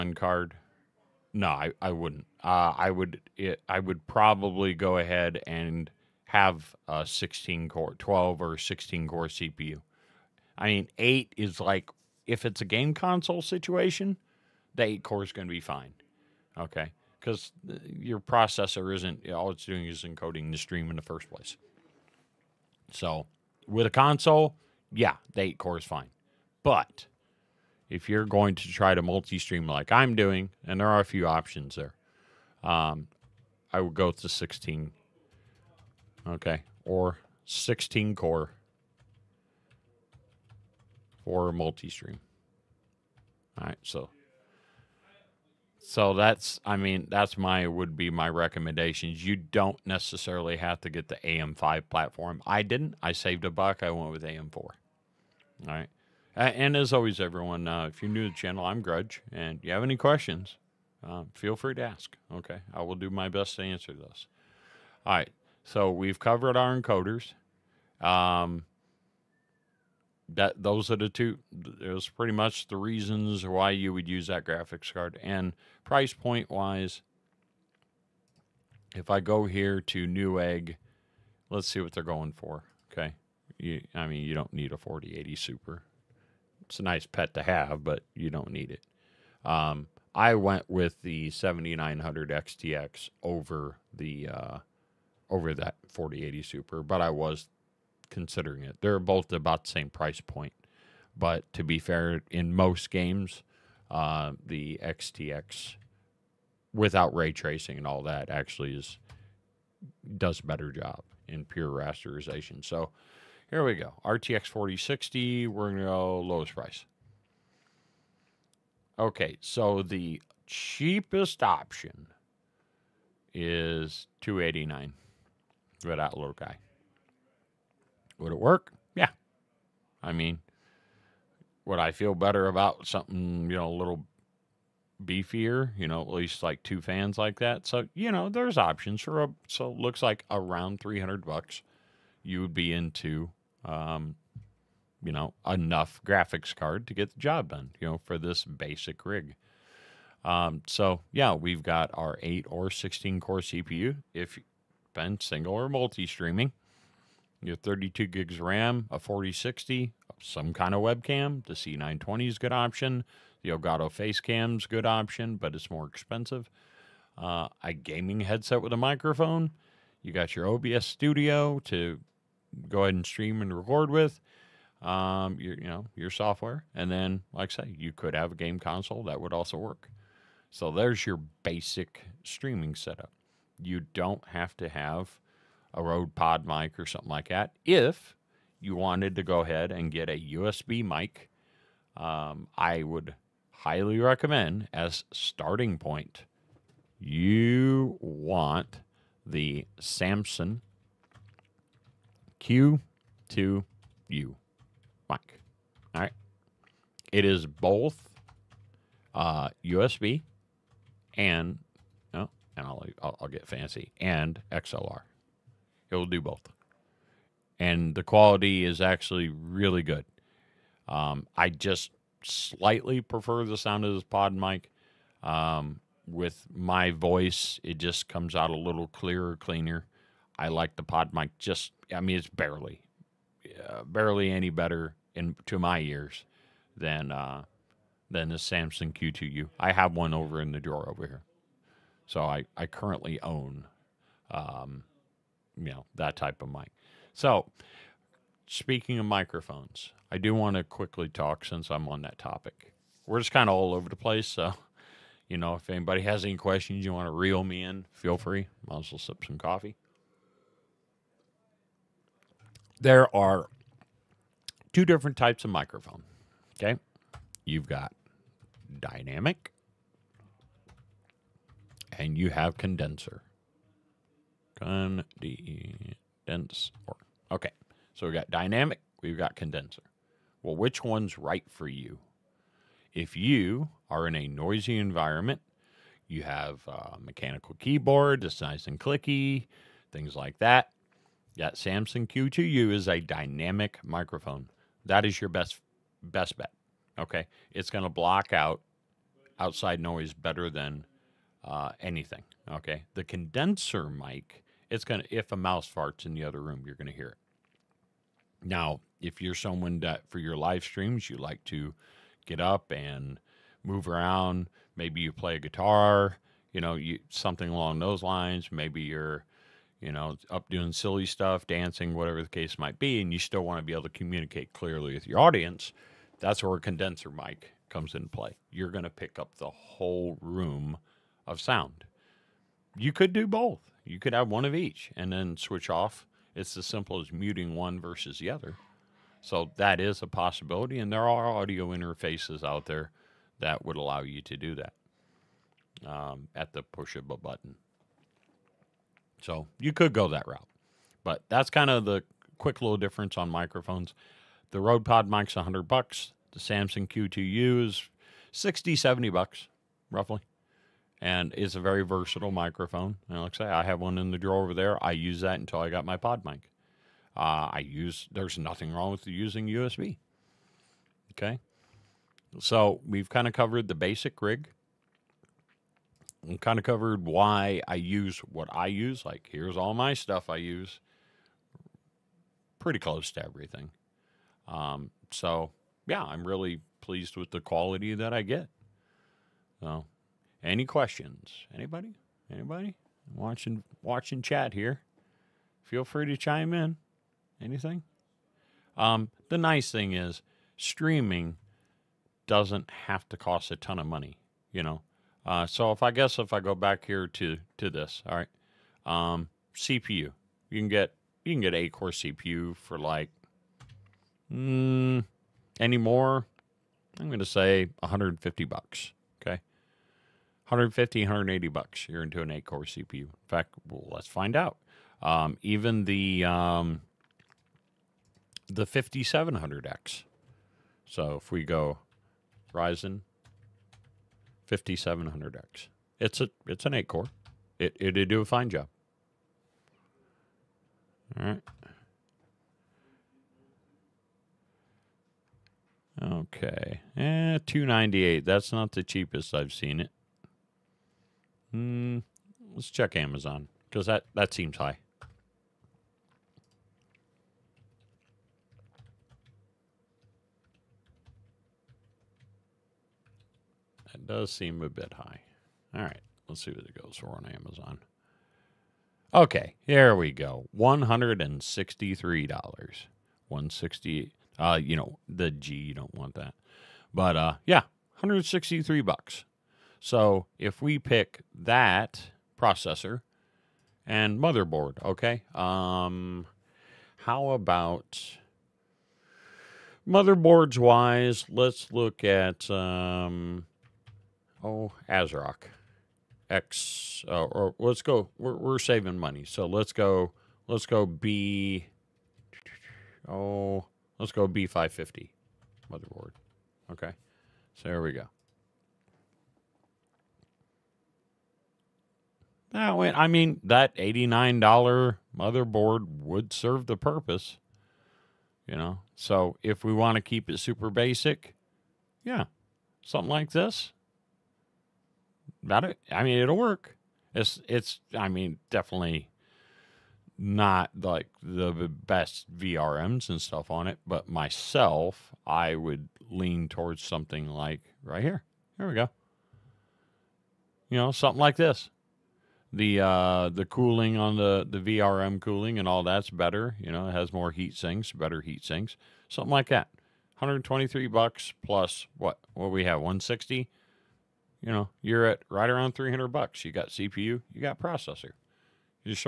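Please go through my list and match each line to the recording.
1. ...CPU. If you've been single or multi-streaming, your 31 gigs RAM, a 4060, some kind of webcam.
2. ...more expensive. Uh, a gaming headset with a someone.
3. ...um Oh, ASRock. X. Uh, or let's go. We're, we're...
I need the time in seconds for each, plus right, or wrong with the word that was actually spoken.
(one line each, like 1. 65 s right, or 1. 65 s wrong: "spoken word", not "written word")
1. 153 s wrong: "32", not "31"
2. 165 s wrong: "microphone", not "someone"
3. 492 s right.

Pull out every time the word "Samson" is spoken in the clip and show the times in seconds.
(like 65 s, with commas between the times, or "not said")
199 s, 238 s, 291 s, 356 s.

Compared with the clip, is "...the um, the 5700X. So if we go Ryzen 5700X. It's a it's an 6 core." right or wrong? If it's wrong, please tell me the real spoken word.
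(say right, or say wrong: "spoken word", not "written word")
wrong: "8", not "6".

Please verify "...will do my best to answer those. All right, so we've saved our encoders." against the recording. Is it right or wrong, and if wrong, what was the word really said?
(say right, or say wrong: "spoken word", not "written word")
wrong: "covered", not "saved".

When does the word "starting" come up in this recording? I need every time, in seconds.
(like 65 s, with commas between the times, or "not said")
195 s.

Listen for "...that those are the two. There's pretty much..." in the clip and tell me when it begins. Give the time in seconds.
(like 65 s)
70 s.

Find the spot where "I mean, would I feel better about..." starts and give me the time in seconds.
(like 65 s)
130 s.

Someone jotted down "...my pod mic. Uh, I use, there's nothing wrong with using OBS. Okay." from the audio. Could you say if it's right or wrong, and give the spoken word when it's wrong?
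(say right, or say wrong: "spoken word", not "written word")
wrong: "USB", not "OBS".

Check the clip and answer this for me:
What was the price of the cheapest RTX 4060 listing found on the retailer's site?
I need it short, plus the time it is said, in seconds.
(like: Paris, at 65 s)
289, at 124 s.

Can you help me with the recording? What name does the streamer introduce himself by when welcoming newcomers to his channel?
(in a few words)
Grudge.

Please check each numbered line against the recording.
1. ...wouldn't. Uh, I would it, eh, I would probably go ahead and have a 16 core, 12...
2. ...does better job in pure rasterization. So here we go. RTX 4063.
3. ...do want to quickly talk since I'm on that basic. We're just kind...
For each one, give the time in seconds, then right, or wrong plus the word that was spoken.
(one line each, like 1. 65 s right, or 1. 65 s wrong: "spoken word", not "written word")
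1. 1 s right
2. 110 s wrong: "4060", not "4063"
3. 250 s wrong: "topic", not "basic".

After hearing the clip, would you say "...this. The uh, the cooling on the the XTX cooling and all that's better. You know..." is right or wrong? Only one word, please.
wrong.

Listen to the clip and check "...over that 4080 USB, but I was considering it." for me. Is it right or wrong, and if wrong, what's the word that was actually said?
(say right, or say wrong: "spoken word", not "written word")
wrong: "Super", not "USB".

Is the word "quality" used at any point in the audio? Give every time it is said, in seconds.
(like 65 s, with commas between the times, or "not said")
218 s, 387 s.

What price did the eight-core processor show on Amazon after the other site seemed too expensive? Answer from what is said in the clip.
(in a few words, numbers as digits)
$163.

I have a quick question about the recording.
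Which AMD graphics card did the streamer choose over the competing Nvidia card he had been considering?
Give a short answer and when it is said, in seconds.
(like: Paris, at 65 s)
7900 XTX, at 91 s.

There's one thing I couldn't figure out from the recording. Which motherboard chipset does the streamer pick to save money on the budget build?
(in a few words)
B550.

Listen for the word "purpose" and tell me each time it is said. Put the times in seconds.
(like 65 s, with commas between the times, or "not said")
516 s.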